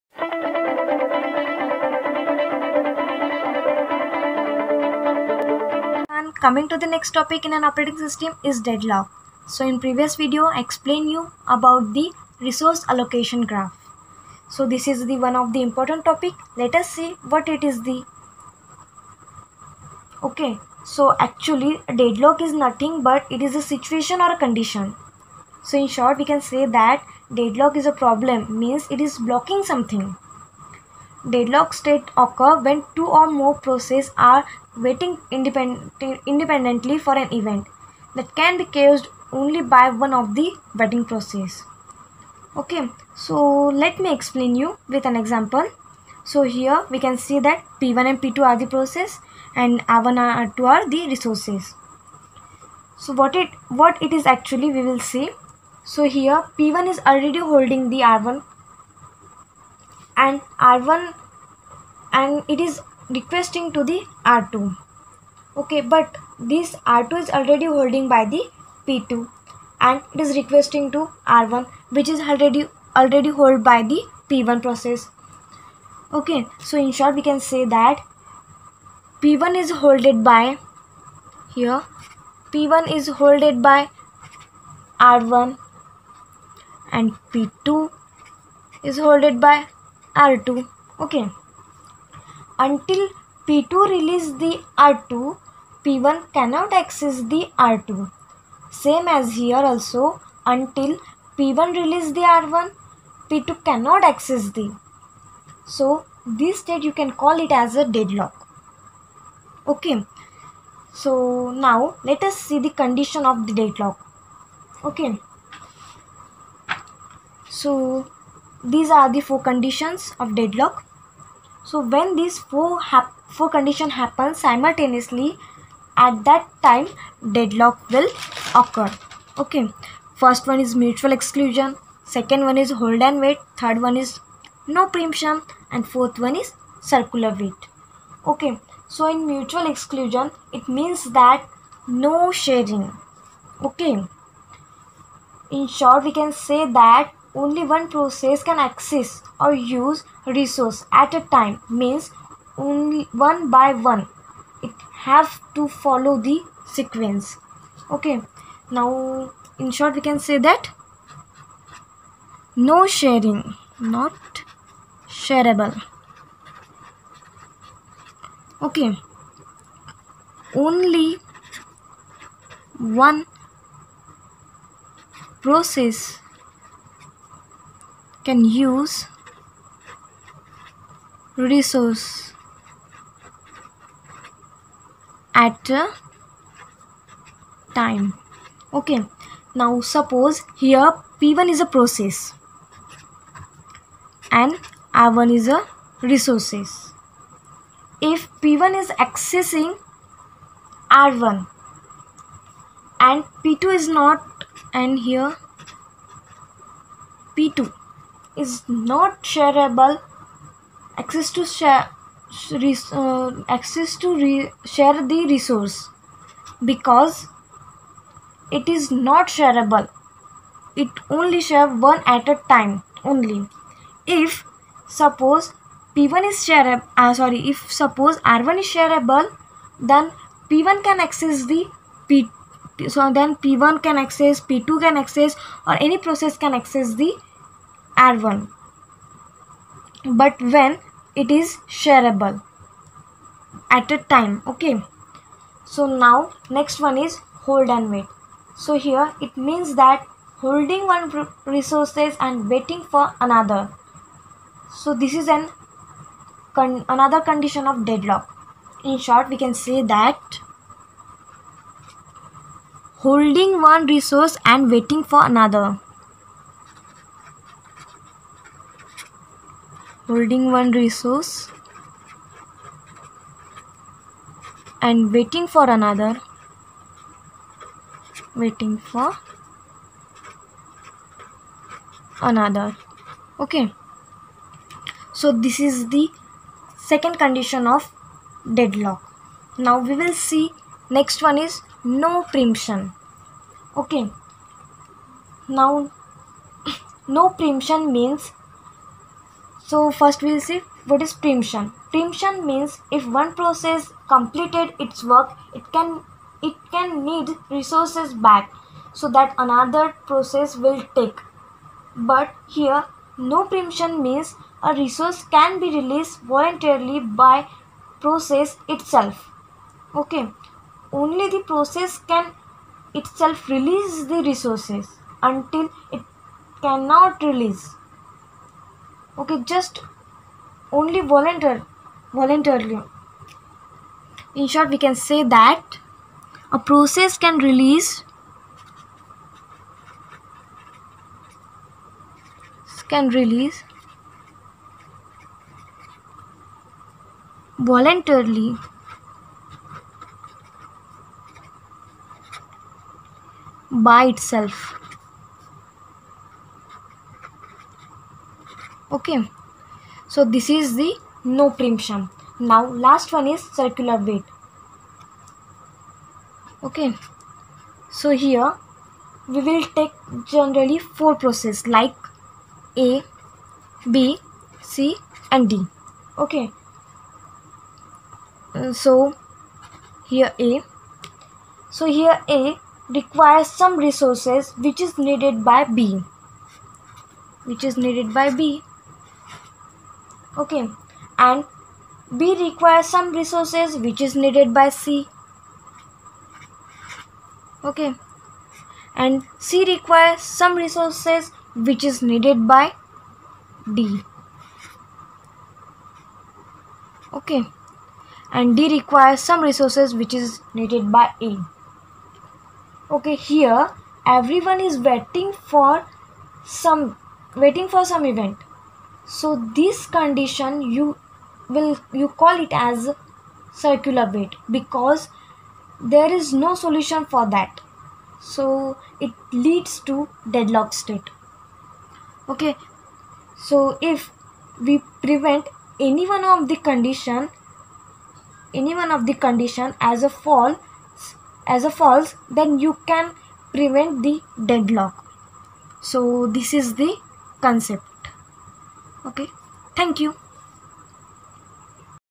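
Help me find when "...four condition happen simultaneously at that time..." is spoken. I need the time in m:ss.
2:03.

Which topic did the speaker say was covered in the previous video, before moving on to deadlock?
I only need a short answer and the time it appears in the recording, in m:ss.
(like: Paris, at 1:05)
Resource allocation graph, at 0:12.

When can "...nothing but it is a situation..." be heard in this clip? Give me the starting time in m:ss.
0:22.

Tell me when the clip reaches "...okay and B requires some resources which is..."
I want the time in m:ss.
6:30.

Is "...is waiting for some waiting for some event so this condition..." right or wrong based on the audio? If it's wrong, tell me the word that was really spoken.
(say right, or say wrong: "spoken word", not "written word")
right.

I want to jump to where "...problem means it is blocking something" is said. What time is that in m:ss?
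0:28.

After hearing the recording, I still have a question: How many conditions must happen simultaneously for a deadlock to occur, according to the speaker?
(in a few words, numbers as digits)
4.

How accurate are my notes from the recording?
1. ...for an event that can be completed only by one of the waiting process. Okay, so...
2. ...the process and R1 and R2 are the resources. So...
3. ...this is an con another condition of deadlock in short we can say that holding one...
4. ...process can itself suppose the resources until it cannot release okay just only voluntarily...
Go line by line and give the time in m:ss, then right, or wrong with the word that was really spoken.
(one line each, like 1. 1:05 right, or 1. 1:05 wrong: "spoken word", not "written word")
1. 0:36 wrong: "caused", not "completed"
2. 0:48 right
3. 4:15 right
4. 5:21 wrong: "release", not "suppose".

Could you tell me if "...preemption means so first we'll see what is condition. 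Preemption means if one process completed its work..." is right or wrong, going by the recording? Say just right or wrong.
wrong.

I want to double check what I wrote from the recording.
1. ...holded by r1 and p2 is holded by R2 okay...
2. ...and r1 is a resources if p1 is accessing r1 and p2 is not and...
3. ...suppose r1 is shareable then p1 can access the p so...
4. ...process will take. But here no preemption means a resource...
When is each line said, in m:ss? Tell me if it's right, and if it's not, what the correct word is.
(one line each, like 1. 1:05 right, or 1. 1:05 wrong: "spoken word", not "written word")
1. 1:23 right
2. 3:14 right
3. 3:47 right
4. 5:10 right.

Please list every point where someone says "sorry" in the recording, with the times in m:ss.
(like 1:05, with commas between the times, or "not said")
3:47.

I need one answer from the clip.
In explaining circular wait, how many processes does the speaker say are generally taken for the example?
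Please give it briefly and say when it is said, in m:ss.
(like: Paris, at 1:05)
4, at 6:10.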